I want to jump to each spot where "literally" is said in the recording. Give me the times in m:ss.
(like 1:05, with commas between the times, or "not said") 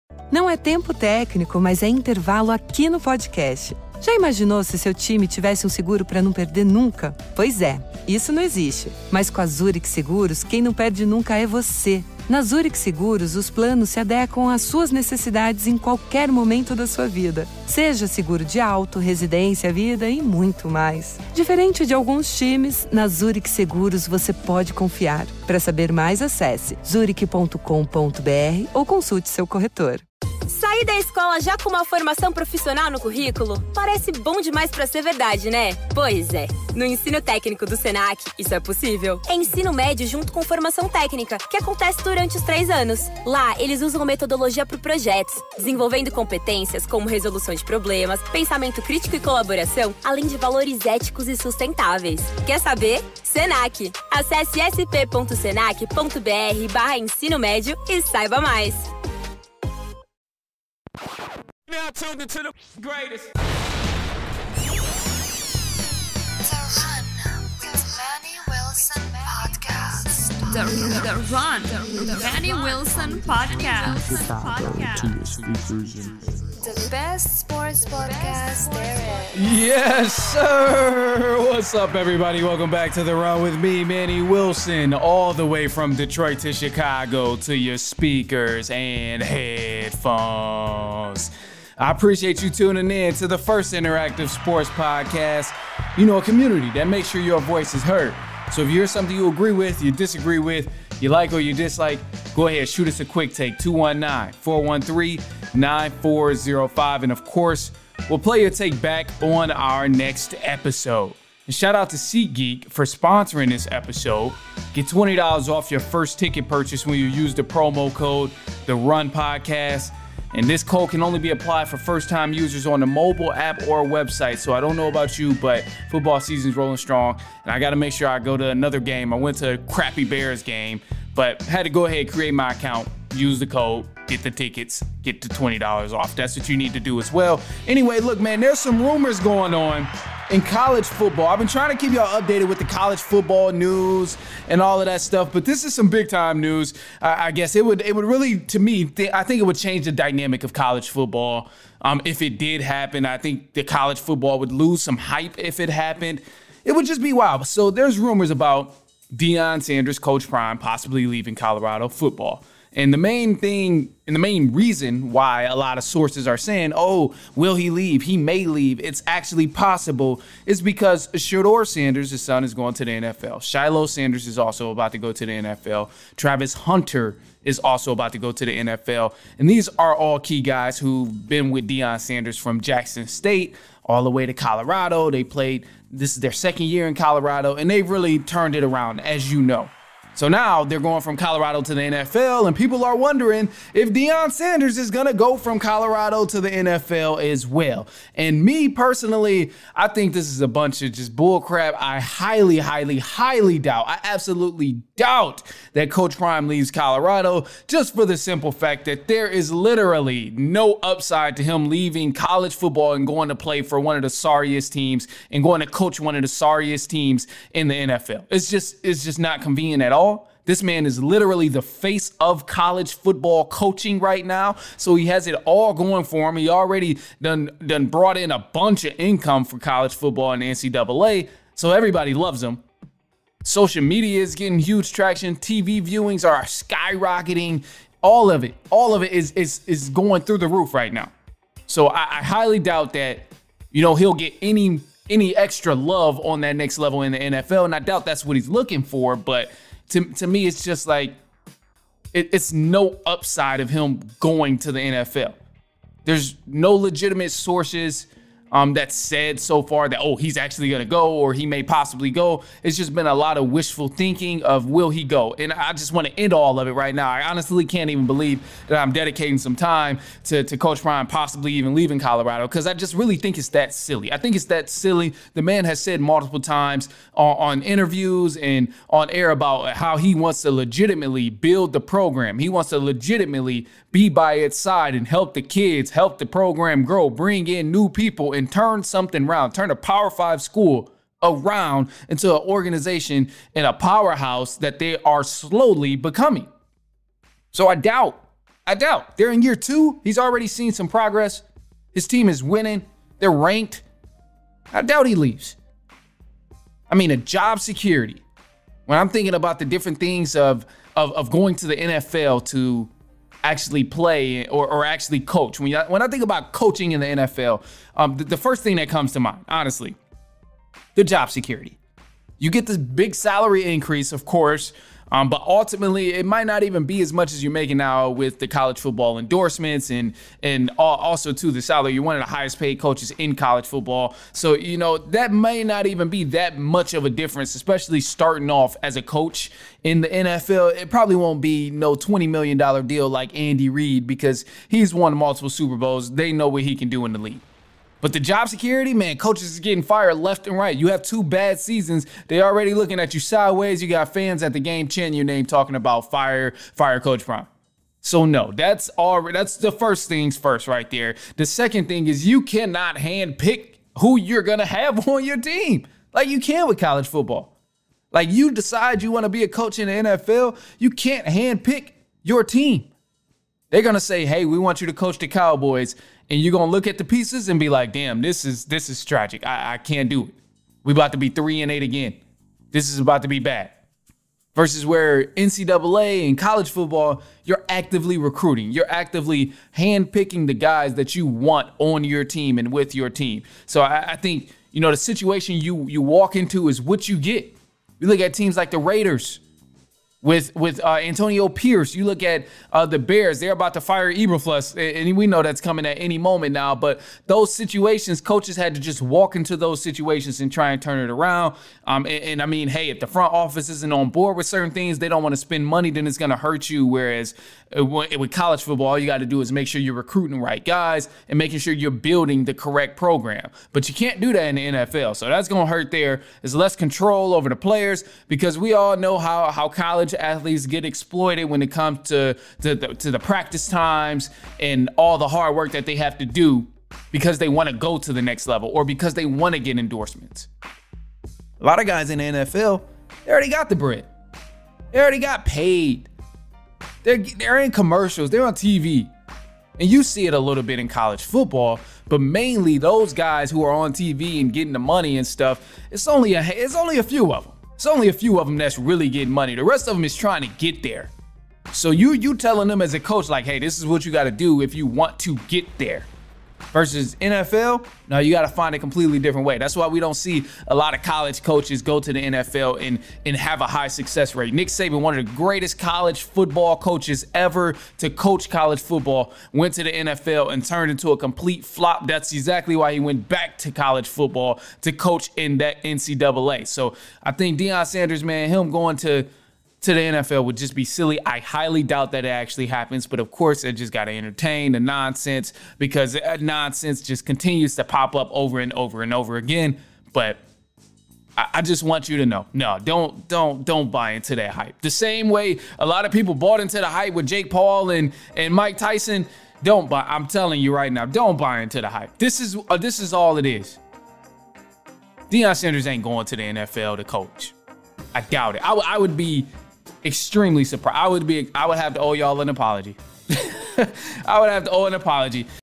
3:29, 3:41.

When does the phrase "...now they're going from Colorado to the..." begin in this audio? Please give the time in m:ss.
3:10.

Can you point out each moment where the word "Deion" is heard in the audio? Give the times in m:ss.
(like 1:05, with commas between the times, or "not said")
2:39, 3:01, 3:13, 8:07, 8:35.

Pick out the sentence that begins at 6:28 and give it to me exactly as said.
You're actively handpicking the guys that you want on your team and with your team.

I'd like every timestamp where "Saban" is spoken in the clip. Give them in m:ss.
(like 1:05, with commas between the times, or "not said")
7:54.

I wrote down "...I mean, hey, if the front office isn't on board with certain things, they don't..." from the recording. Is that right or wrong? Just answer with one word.
right.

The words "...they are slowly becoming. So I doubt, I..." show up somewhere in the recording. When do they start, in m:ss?
4:54.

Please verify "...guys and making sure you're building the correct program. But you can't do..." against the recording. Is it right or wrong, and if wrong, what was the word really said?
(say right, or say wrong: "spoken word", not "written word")
right.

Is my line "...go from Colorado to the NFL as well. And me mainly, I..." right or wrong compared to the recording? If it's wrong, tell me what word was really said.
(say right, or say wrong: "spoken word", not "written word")
wrong: "personally", not "mainly".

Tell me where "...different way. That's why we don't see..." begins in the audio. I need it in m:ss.
7:49.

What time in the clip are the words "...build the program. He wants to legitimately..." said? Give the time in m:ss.
4:41.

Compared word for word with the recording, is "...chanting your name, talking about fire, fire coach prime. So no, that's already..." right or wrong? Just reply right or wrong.
right.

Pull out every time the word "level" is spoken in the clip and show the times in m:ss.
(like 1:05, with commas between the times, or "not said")
4:06, 7:18.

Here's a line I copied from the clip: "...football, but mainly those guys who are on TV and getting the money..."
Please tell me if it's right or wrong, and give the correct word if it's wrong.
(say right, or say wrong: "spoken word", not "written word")
right.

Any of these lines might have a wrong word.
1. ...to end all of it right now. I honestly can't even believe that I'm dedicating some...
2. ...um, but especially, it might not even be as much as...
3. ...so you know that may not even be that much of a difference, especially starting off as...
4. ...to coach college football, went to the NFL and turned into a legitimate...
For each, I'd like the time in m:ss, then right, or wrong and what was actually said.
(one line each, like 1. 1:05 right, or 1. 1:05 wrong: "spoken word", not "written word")
1. 4:26 right
2. 5:25 wrong: "ultimately", not "especially"
3. 5:34 right
4. 7:57 wrong: "complete", not "legitimate".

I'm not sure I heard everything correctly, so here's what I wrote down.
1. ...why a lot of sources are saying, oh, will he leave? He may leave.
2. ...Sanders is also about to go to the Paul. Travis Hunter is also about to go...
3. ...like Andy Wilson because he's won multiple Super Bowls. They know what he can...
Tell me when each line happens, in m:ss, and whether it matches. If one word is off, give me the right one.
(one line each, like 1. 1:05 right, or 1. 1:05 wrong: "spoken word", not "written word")
1. 2:45 right
2. 2:53 wrong: "NFL", not "Paul"
3. 5:43 wrong: "Reid", not "Wilson".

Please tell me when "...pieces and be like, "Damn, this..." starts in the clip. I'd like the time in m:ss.
6:17.